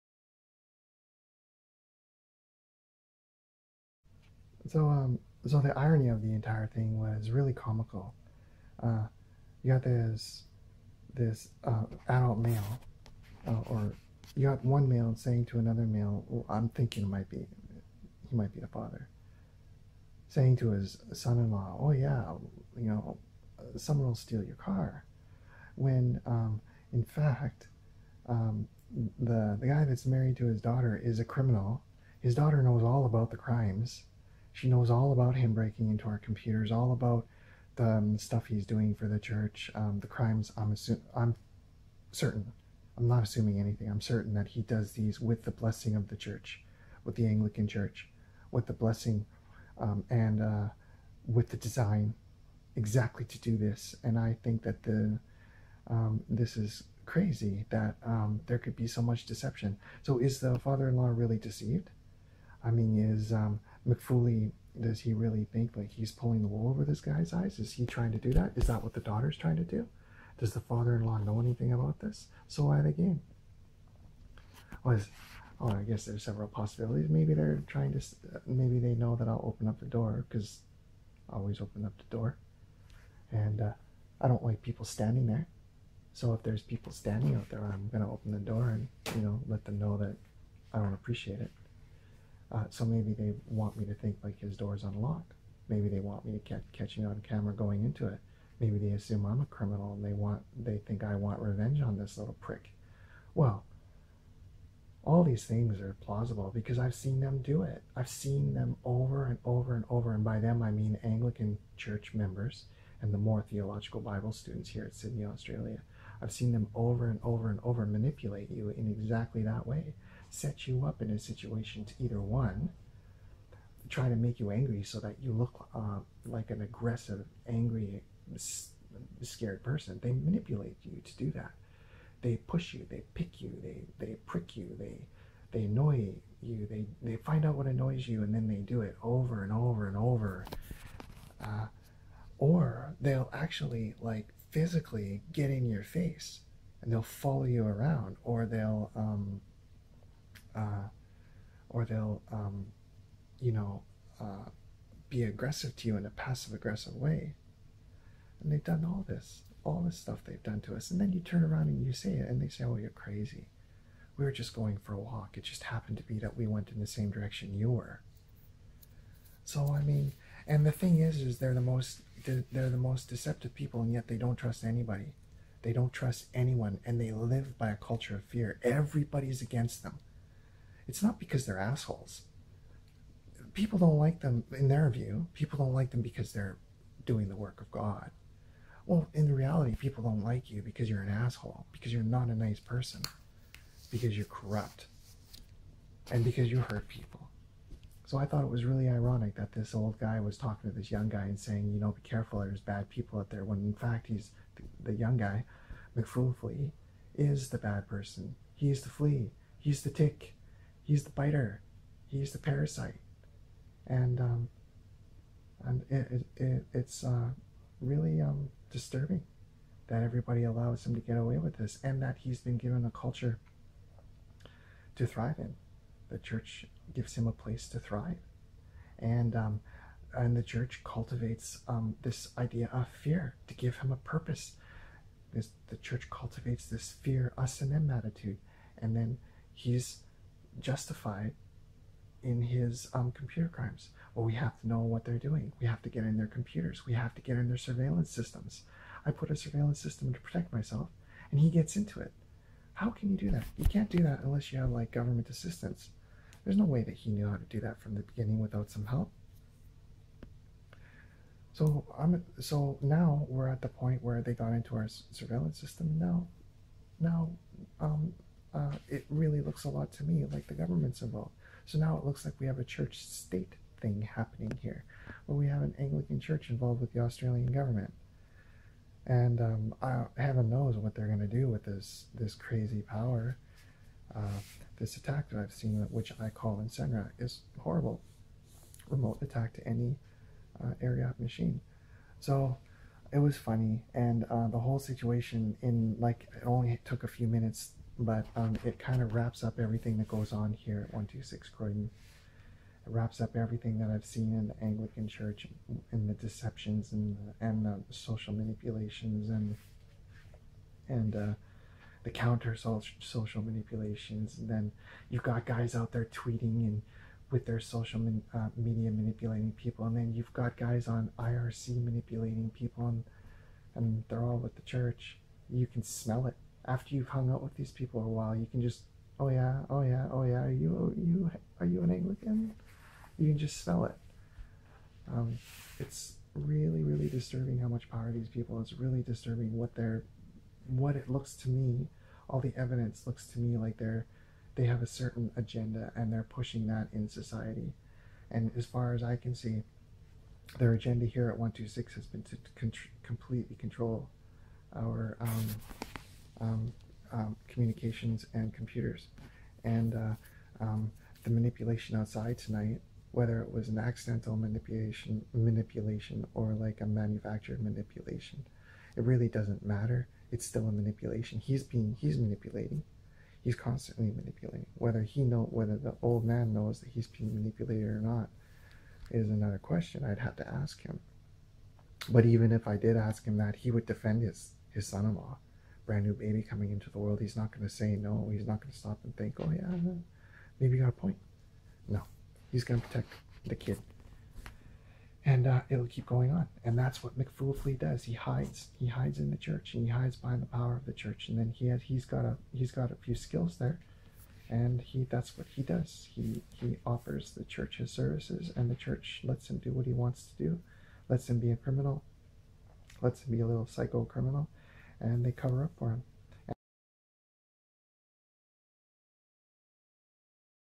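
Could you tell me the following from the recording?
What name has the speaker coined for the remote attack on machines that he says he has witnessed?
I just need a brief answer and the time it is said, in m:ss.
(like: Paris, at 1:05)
Incendiac, at 4:46.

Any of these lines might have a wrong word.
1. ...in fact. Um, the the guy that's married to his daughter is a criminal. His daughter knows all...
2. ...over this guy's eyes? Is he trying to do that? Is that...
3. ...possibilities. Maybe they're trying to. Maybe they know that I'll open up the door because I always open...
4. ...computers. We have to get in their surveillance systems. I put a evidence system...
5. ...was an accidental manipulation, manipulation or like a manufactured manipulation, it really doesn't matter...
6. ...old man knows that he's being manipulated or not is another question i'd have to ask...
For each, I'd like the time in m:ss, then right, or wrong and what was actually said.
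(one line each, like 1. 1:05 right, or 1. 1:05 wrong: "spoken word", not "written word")
1. 0:26 right
2. 1:06 right
3. 1:16 right
4. 4:06 wrong: "surveillance", not "evidence"
5. 6:03 right
6. 6:16 right.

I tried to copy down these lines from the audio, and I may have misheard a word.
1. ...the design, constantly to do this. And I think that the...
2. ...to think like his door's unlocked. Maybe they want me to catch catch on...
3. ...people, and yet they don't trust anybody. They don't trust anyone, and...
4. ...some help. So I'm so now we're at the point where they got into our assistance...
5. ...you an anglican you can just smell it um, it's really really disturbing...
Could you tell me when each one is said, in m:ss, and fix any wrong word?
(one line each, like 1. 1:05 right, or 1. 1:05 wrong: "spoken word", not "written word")
1. 0:51 wrong: "exactly", not "constantly"
2. 1:33 right
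3. 2:53 right
4. 4:18 wrong: "surveillance", not "assistance"
5. 5:31 right.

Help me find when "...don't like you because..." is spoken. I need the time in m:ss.
3:10.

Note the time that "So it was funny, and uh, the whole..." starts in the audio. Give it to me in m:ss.
4:52.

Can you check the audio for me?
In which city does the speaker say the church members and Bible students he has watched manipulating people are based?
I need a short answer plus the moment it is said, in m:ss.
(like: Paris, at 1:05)
Sydney, at 1:54.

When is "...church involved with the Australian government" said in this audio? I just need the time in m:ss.
4:36.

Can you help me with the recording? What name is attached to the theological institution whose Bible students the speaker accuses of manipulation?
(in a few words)
Moore.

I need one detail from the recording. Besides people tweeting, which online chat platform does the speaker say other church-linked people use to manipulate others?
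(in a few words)
IRC.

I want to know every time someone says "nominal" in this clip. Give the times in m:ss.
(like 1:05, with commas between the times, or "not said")
not said.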